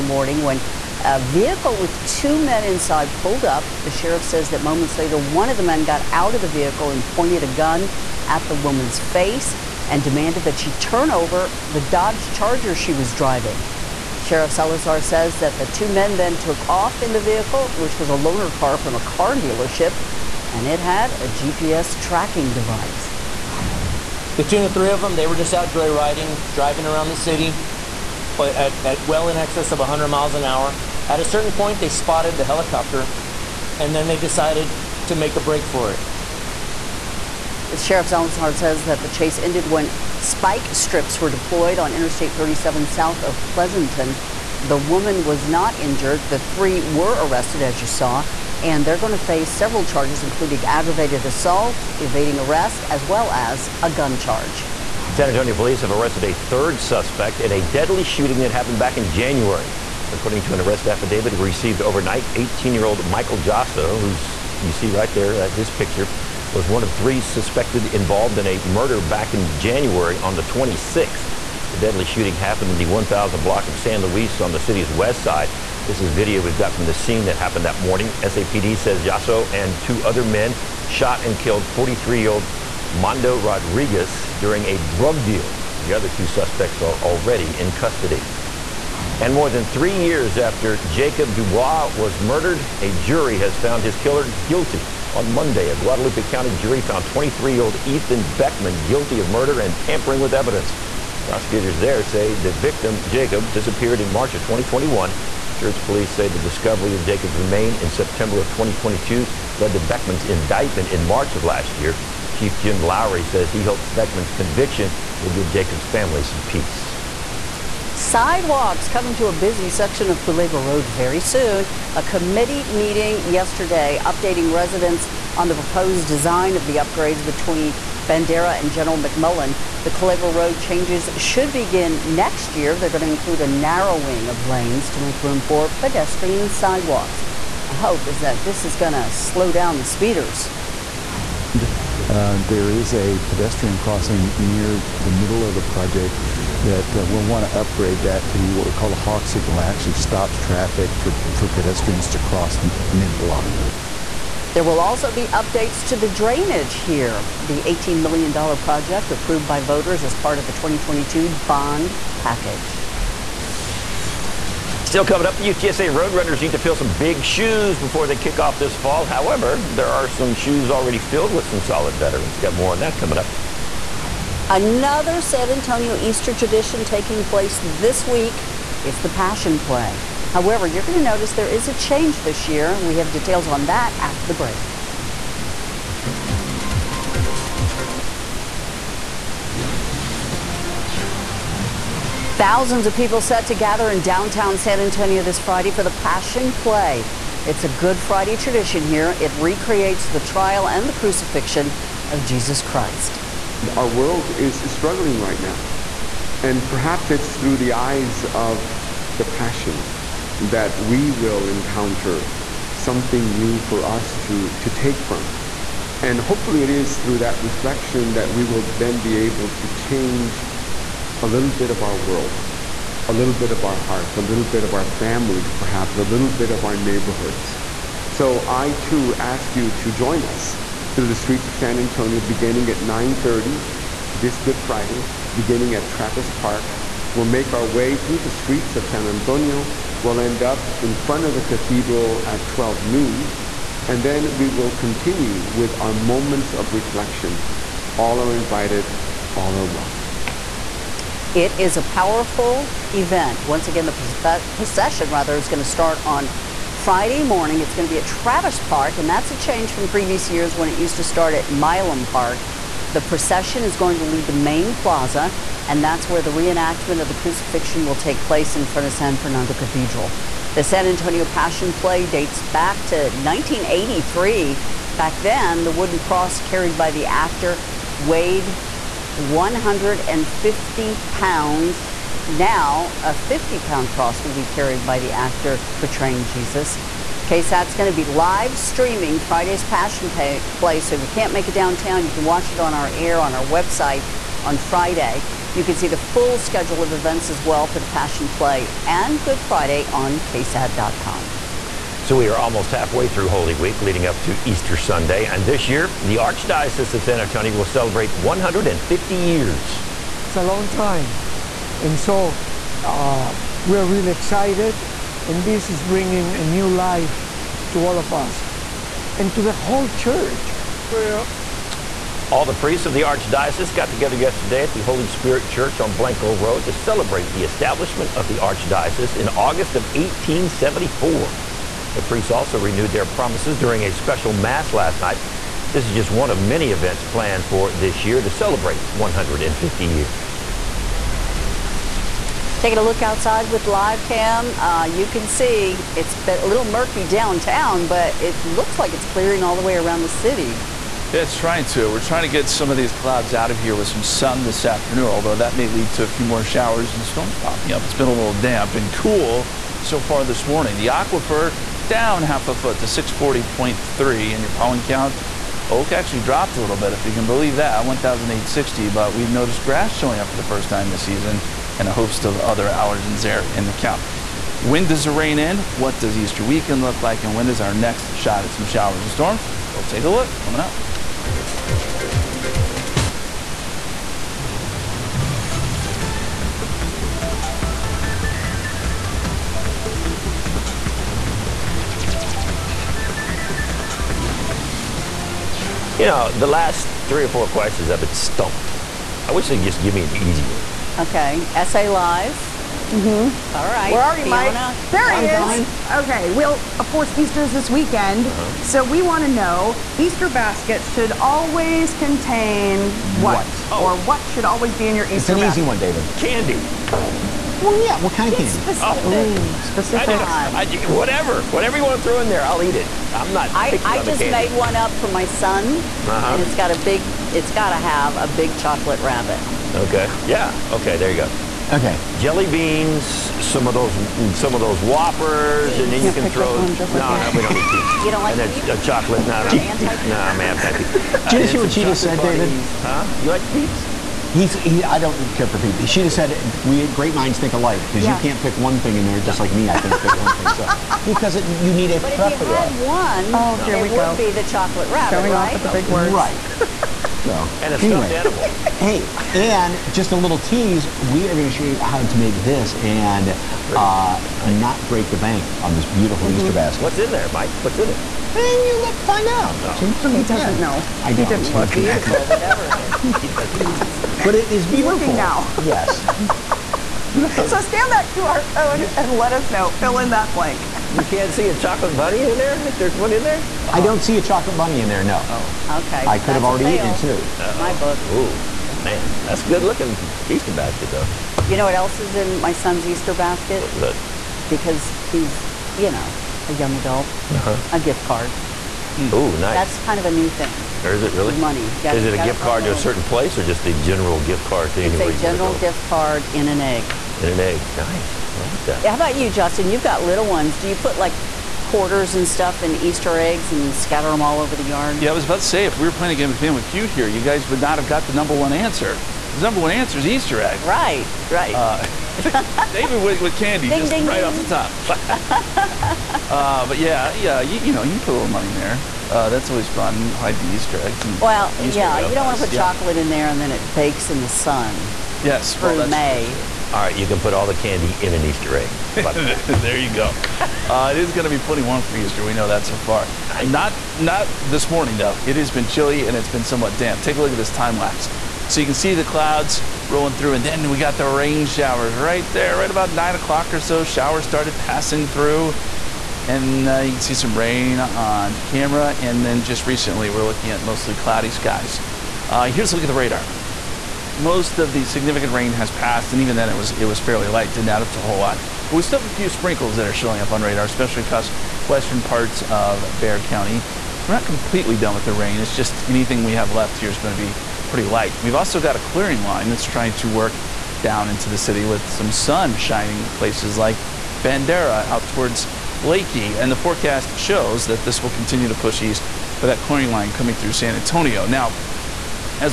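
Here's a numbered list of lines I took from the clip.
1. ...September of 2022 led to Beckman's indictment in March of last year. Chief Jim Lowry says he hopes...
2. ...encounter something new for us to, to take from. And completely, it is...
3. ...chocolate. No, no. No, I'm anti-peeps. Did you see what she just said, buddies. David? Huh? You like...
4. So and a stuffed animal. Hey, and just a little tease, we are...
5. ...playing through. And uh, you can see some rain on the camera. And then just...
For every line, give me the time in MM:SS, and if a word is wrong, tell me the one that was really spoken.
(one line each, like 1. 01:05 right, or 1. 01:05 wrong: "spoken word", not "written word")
1. 01:47 right
2. 03:31 wrong: "hopefully", not "completely"
3. 07:18 right
4. 07:37 right
5. 09:14 wrong: "passing", not "playing".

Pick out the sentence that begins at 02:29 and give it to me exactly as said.
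It actually stops traffic for, for pedestrians to cross mid-block.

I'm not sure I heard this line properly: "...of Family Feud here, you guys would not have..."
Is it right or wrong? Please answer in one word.
right.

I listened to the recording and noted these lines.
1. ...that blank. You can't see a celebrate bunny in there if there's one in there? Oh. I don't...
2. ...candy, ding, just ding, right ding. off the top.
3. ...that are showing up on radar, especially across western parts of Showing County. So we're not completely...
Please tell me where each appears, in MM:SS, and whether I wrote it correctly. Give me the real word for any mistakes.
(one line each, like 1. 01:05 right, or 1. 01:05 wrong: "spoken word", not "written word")
1. 08:00 wrong: "chocolate", not "celebrate"
2. 08:43 right
3. 09:29 wrong: "Bexar", not "Showing".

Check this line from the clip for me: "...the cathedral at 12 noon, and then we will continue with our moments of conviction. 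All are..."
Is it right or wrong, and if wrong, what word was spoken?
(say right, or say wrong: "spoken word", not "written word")
wrong: "reflection", not "conviction".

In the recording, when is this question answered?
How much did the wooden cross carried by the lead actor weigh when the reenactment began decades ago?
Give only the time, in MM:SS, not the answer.
04:39.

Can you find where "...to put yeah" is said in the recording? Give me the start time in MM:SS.
08:52.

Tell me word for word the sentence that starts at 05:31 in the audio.
The priests also renewed their promises during a special Mass last night.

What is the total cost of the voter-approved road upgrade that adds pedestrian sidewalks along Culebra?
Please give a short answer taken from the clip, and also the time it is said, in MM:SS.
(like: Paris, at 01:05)
$18 million, at 02:37.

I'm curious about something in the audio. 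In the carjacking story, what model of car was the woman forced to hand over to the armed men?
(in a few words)
Dodge Charger.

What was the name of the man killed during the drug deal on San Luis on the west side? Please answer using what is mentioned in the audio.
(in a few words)
Mondo Rodriguez.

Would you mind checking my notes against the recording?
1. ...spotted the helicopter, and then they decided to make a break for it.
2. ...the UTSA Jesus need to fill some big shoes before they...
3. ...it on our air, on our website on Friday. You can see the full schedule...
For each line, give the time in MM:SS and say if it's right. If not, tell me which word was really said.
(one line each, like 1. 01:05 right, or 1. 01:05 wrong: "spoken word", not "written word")
1. 00:31 right
2. 02:45 wrong: "Roadrunners", not "Jesus"
3. 04:52 right.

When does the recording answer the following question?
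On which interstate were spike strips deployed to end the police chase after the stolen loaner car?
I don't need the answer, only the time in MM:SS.
00:41.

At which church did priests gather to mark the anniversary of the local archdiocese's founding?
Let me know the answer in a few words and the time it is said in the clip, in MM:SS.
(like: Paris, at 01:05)
Holy Spirit Church, at 05:24.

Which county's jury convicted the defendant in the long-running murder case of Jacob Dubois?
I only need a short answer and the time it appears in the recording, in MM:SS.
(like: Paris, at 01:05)
Guadalupe County, at 01:35.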